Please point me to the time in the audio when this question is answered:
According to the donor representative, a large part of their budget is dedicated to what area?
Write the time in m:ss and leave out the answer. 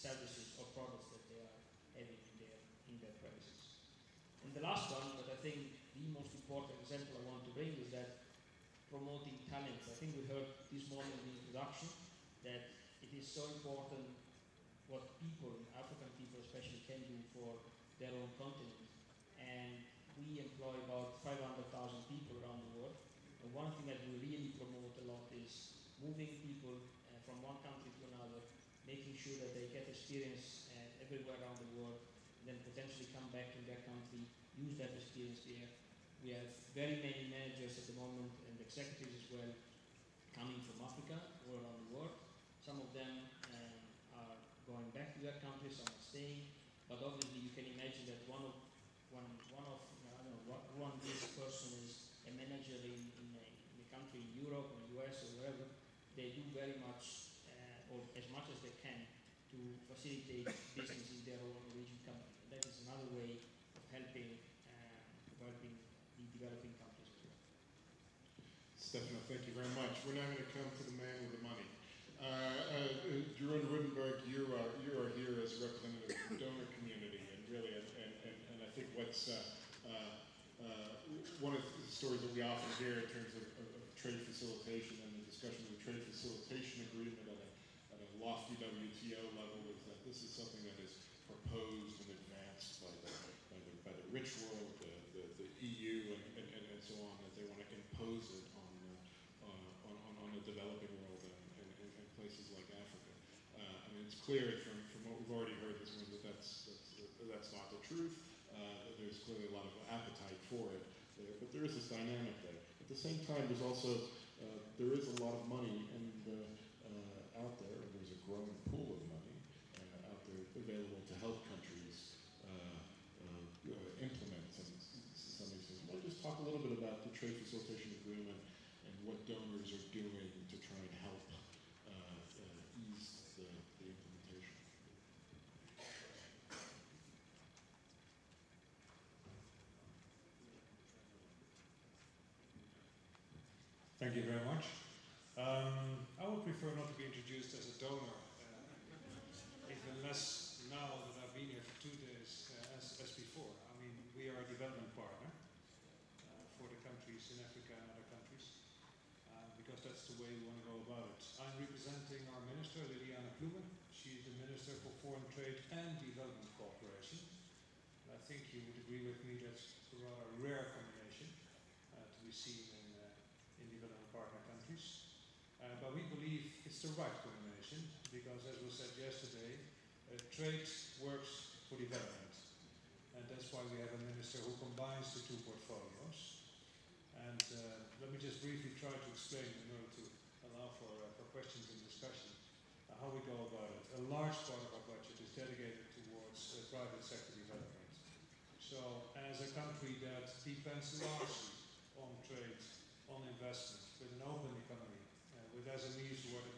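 3:16.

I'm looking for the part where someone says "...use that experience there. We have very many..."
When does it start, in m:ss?
0:34.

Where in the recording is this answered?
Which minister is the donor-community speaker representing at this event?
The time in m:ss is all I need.
2:42.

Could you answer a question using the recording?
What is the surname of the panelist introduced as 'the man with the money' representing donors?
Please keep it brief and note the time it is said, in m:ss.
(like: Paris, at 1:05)
Roodenburg, at 1:13.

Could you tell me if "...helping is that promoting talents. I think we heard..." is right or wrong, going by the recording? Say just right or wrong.
wrong.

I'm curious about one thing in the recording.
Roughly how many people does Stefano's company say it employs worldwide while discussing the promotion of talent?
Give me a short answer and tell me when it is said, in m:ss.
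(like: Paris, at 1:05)
500,000, at 0:21.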